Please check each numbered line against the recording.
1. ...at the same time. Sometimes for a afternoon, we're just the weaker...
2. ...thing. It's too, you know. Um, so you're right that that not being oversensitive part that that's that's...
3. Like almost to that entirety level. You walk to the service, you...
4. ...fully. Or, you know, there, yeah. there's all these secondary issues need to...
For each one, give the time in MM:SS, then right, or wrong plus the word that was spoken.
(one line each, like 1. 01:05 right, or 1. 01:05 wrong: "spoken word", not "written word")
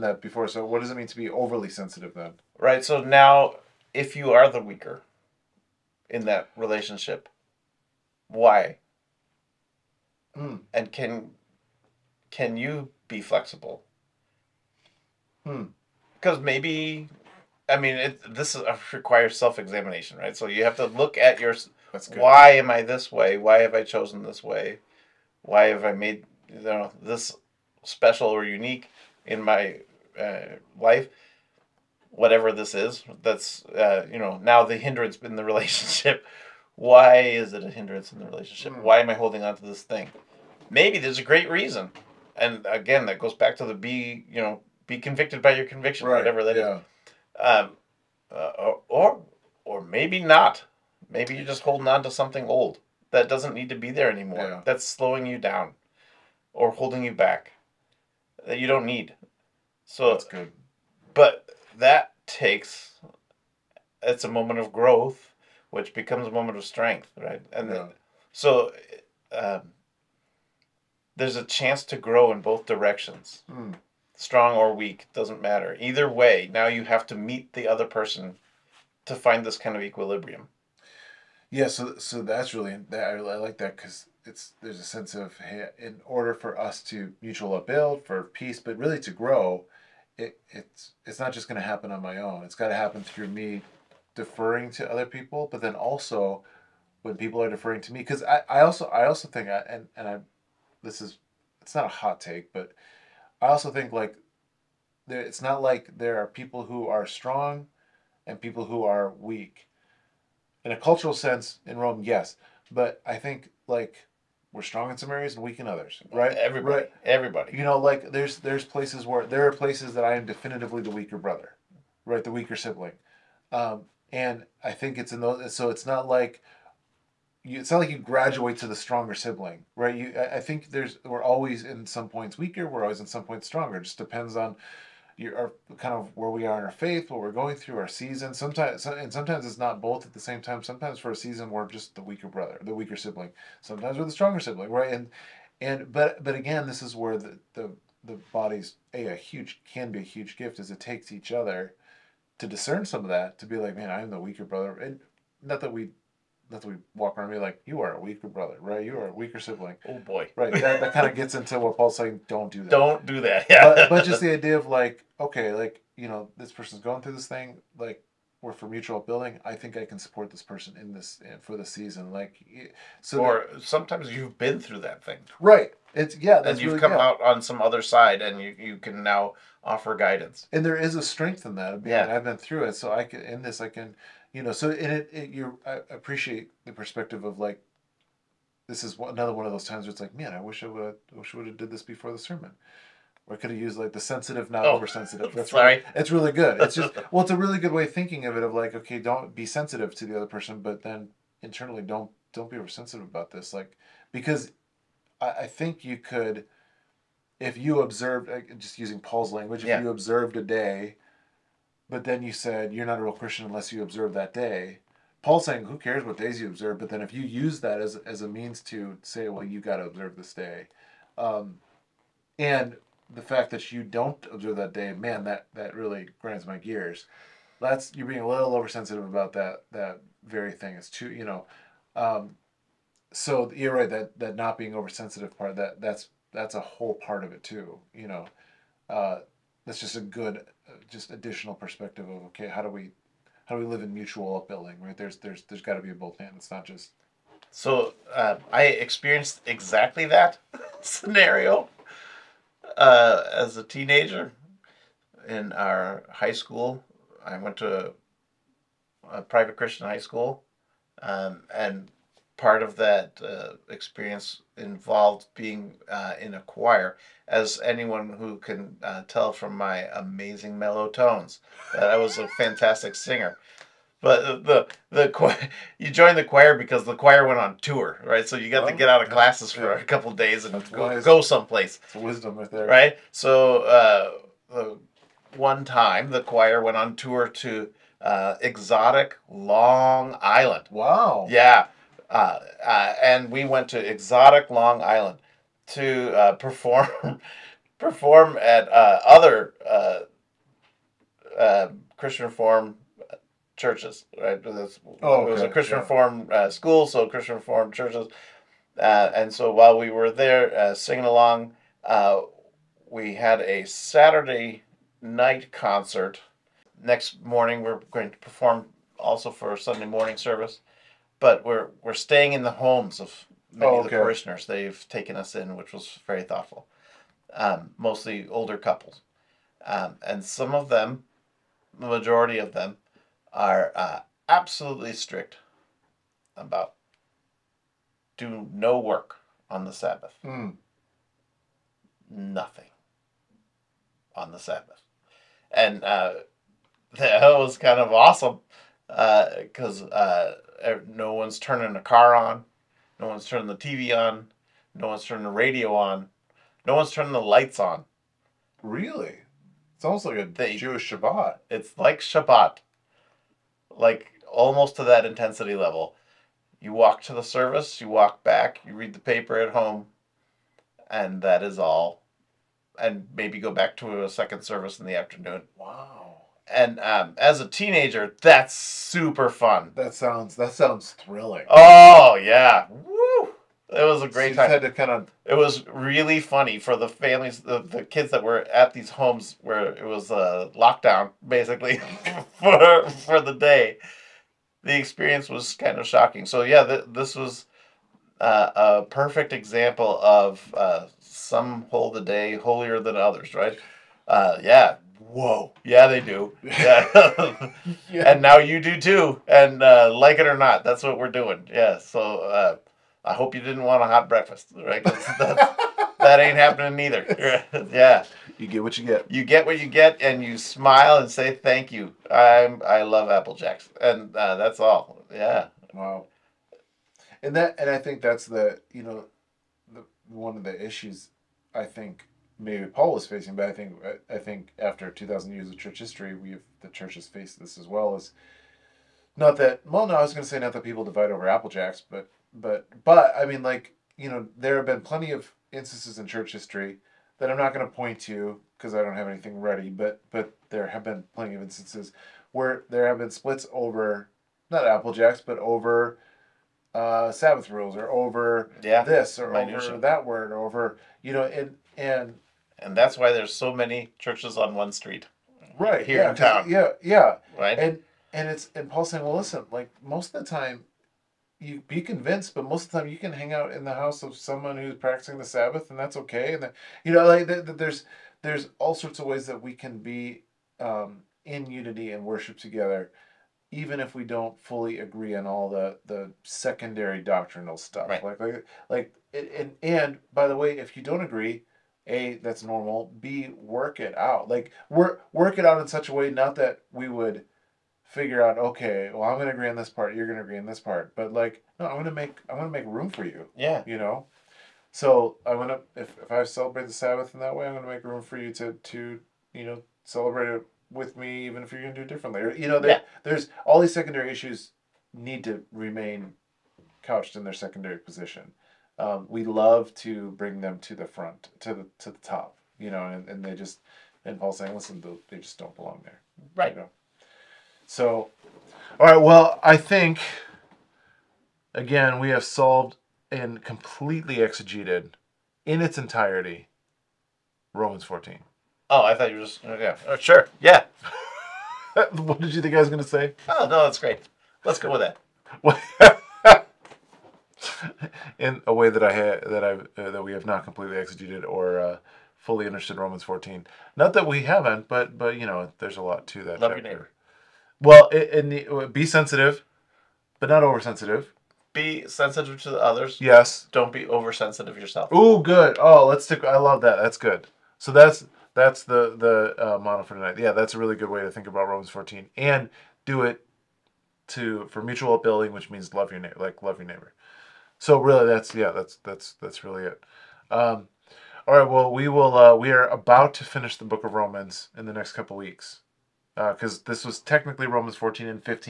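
1. 02:20 wrong: "season", not "afternoon"
2. 03:50 right
3. 06:03 wrong: "intensity", not "entirety"
4. 08:31 wrong: "differently", not "fully".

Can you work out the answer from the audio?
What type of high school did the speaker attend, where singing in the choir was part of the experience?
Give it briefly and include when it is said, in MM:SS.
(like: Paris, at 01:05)
private Christian high school, at 04:19.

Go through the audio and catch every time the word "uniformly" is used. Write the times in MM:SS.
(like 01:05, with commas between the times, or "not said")
not said.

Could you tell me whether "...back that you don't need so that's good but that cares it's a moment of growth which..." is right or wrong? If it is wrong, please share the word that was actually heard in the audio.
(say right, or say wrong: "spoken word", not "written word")
wrong: "takes", not "cares".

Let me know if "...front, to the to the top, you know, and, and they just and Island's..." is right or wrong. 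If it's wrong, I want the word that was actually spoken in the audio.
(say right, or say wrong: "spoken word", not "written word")
wrong: "Paul", not "Island".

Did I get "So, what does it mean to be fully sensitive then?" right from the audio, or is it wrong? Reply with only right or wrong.
wrong.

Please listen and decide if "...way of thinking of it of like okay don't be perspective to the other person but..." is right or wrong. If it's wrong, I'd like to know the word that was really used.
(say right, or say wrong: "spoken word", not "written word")
wrong: "sensitive", not "perspective".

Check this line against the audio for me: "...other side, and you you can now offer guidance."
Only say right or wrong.
right.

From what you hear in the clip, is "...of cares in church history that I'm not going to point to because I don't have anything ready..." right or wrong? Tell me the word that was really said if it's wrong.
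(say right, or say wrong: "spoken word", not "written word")
wrong: "instances", not "cares".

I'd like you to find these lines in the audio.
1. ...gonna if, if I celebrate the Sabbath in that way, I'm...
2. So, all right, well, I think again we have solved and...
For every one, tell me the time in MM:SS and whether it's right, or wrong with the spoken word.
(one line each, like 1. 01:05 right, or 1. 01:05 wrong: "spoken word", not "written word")
1. 08:25 right
2. 08:47 right.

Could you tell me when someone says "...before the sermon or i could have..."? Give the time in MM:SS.
03:11.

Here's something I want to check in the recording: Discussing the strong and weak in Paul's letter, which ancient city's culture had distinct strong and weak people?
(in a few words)
Rome.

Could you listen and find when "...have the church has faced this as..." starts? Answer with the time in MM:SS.
07:16.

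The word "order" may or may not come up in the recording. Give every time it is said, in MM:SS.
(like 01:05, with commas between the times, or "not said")
01:26.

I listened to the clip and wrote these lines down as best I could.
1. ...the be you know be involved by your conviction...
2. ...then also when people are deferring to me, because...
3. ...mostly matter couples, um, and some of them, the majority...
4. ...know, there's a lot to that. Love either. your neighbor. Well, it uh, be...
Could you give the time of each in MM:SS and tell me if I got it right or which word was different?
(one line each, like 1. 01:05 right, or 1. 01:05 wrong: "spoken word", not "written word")
1. 00:43 wrong: "convicted", not "involved"
2. 01:35 right
3. 05:27 wrong: "older", not "matter"
4. 09:15 wrong: "chapter", not "either".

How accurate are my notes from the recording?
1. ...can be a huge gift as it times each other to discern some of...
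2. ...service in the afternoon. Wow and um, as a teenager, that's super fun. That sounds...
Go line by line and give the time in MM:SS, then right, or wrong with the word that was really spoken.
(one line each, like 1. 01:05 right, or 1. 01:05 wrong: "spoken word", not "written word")
1. 02:29 wrong: "takes", not "times"
2. 06:14 right.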